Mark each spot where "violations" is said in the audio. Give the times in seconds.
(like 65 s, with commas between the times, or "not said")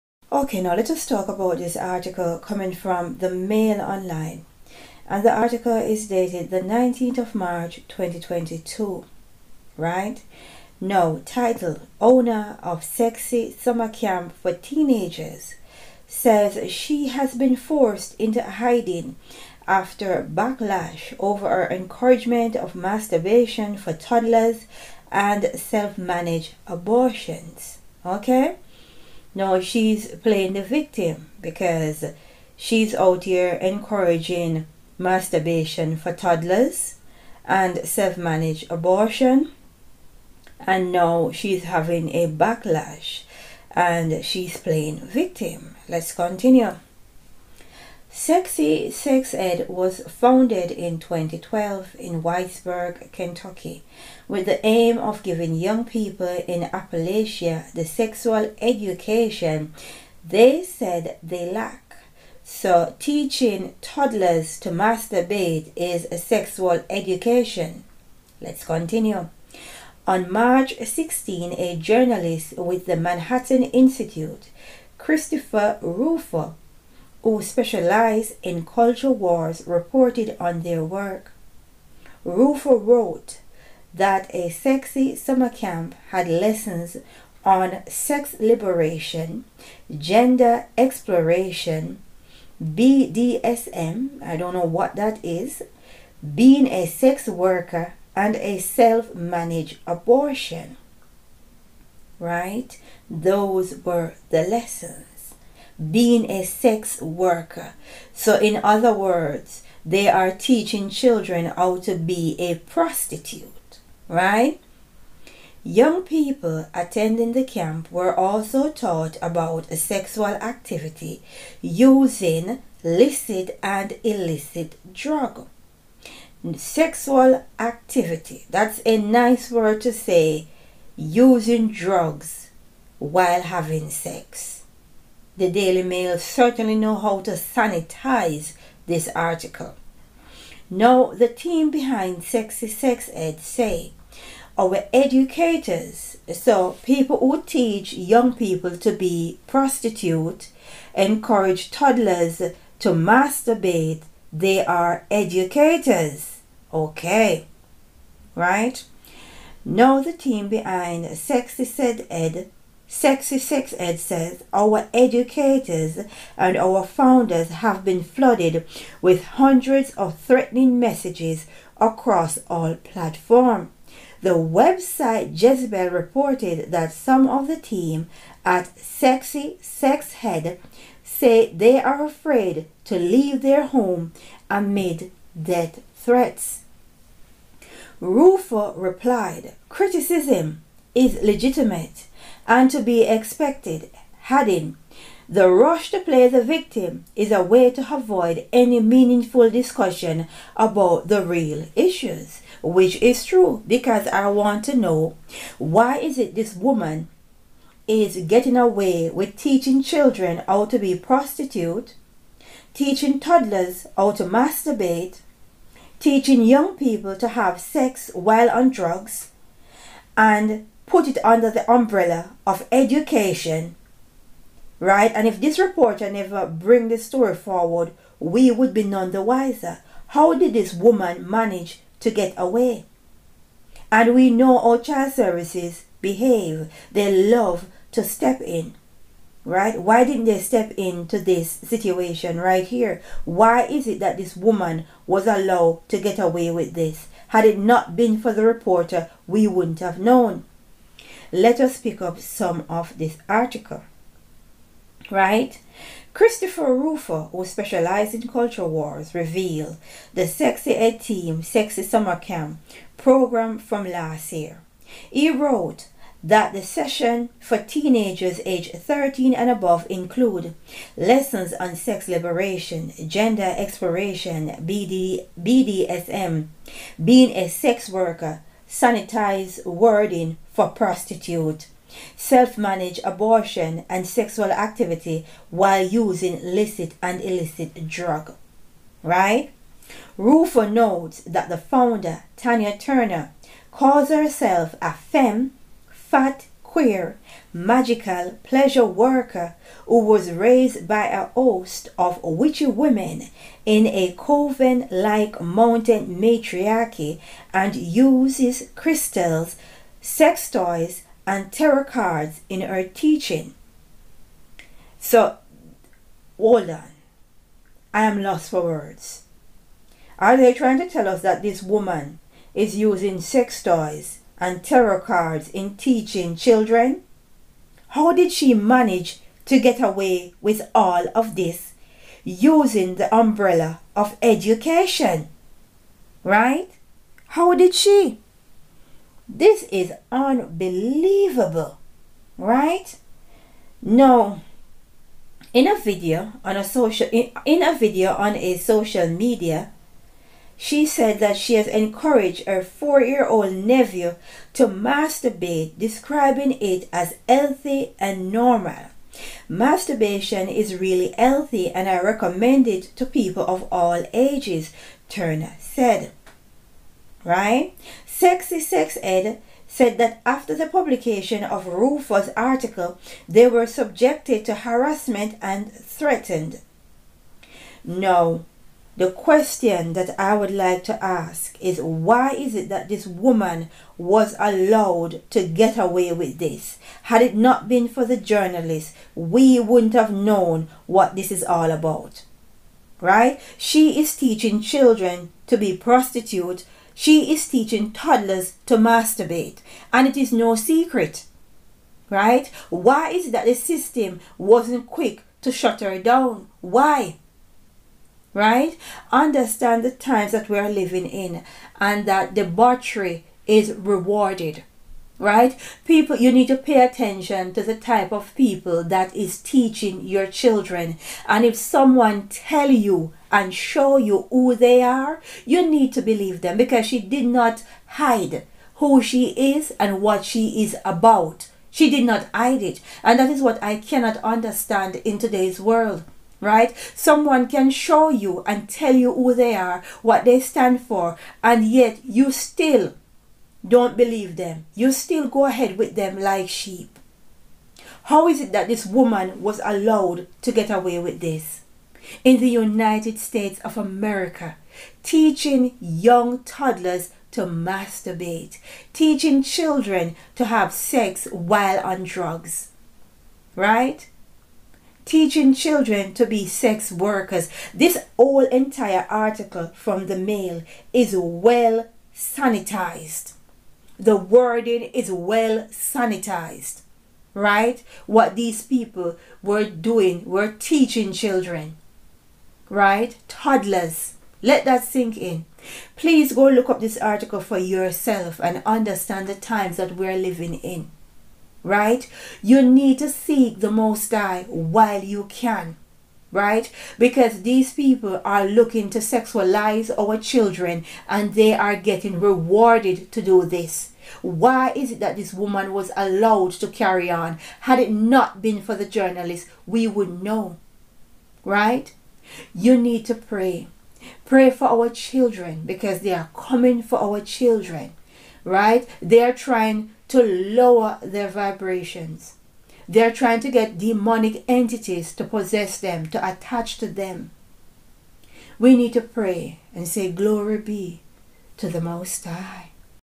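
not said.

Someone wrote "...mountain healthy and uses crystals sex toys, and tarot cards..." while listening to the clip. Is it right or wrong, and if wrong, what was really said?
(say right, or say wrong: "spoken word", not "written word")
wrong: "matriarchy", not "healthy".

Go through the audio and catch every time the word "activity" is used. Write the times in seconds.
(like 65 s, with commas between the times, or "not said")
120 s, 127 s, 284 s.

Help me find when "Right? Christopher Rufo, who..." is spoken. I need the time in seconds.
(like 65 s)
255 s.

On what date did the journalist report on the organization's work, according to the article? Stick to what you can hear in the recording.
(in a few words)
March 16.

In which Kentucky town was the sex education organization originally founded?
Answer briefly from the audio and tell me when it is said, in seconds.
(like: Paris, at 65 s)
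Whitesburg, at 52 s.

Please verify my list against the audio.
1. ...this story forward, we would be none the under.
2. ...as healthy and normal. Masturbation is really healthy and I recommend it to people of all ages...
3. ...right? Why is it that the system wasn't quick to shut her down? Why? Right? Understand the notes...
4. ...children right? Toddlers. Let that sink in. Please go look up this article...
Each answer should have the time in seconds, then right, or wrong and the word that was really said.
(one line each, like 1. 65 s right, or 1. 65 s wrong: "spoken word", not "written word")
1. 226 s wrong: "wiser", not "under"
2. 356 s right
3. 402 s wrong: "times", not "notes"
4. 481 s right.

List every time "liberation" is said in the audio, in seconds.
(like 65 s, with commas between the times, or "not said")
88 s, 272 s.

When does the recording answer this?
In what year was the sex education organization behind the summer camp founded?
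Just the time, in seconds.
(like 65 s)
50 s.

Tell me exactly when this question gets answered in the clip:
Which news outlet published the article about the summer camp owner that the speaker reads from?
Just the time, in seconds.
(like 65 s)
3 s.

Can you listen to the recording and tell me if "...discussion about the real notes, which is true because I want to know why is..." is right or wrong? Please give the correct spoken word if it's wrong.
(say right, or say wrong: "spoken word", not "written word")
wrong: "issues", not "notes".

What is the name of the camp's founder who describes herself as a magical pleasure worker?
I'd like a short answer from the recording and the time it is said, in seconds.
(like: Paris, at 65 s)
Tanya Turner, at 292 s.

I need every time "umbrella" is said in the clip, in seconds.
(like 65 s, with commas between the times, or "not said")
221 s, 333 s.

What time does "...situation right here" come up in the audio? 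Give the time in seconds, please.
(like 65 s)
241 s.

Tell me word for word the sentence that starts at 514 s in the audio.
Pray for our children because they are coming for our children, right?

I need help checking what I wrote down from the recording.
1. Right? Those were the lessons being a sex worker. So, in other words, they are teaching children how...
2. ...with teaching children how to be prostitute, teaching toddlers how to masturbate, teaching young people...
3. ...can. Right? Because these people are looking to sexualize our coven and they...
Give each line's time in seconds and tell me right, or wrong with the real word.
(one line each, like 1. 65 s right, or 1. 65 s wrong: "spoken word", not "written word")
1. 102 s right
2. 209 s right
3. 495 s wrong: "children", not "coven".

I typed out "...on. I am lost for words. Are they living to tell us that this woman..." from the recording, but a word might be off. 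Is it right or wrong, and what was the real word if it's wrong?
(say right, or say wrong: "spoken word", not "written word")
wrong: "trying", not "living".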